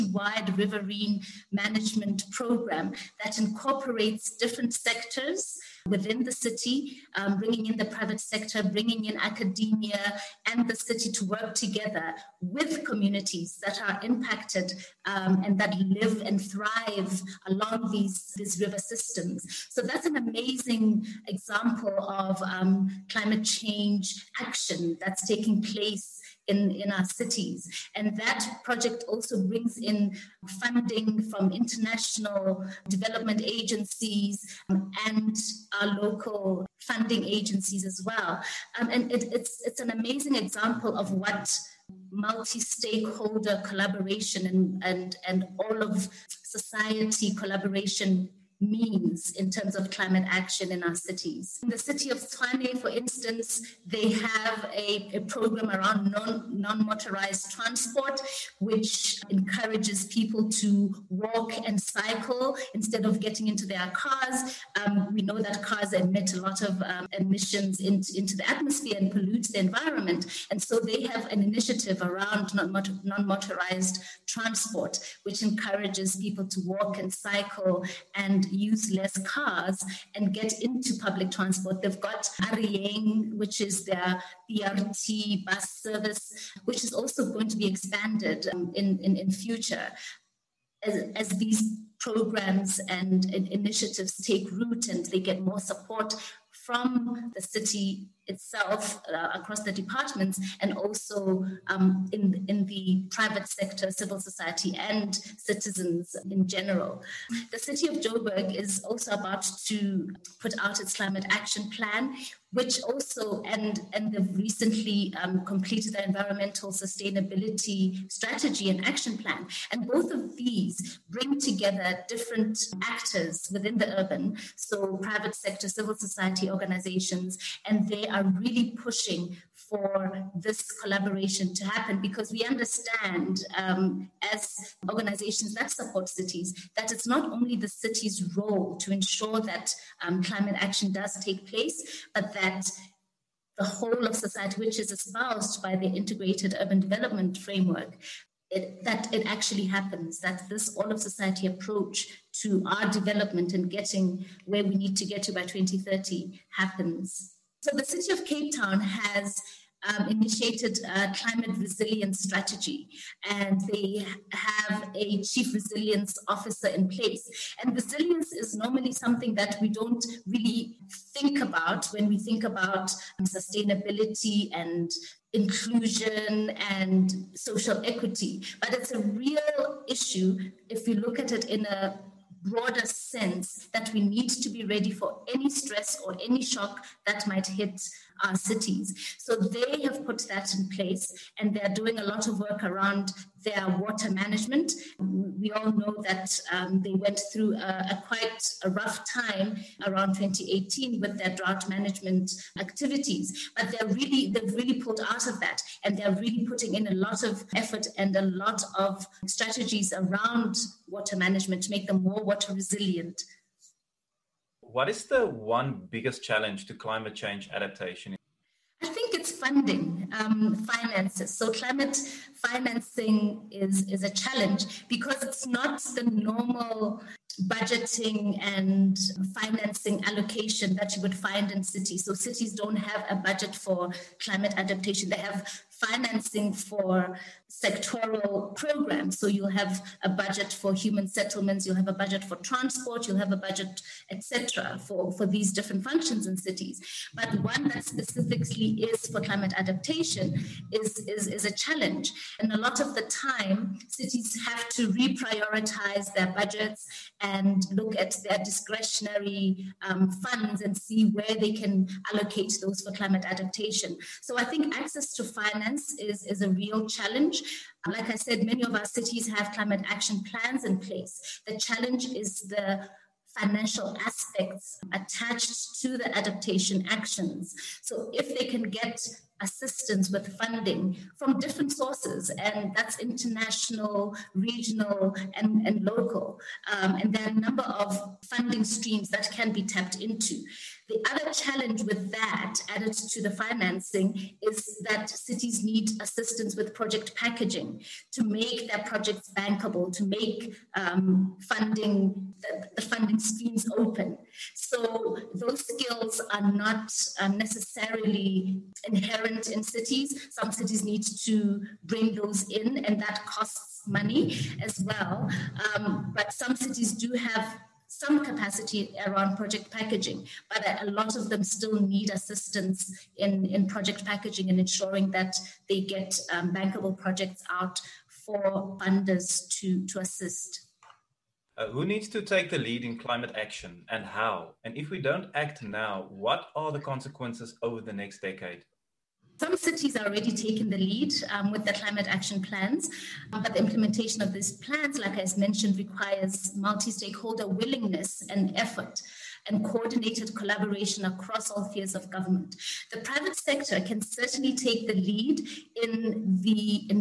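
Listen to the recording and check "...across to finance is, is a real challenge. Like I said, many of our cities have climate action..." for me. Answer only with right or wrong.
wrong.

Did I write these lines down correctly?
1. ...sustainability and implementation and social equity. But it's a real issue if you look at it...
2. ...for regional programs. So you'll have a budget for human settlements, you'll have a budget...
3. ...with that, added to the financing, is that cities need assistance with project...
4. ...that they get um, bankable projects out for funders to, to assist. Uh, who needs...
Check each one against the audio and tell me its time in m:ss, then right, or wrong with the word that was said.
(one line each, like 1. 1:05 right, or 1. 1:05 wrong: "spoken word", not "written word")
1. 2:53 wrong: "inclusion", not "implementation"
2. 3:56 wrong: "sectoral", not "regional"
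3. 4:51 right
4. 5:25 right.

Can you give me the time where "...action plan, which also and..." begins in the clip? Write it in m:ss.
1:51.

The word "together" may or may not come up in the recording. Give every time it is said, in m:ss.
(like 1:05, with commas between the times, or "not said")
0:11, 2:01.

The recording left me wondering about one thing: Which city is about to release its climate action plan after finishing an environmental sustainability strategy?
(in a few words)
Joburg.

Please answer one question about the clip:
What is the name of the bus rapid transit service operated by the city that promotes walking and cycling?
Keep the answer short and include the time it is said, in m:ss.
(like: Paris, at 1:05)
A Re Yeng, at 1:22.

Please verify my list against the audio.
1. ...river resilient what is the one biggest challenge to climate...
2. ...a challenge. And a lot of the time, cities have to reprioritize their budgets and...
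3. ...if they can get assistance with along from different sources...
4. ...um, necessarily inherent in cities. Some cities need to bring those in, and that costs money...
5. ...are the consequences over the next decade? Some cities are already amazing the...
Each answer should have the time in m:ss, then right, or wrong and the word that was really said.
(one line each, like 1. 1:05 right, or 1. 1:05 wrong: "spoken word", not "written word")
1. 3:32 wrong: "water", not "river"
2. 4:11 right
3. 4:38 wrong: "funding", not "along"
4. 5:07 right
5. 5:36 wrong: "taking", not "amazing".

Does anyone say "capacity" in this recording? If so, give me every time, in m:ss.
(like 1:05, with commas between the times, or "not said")
5:18.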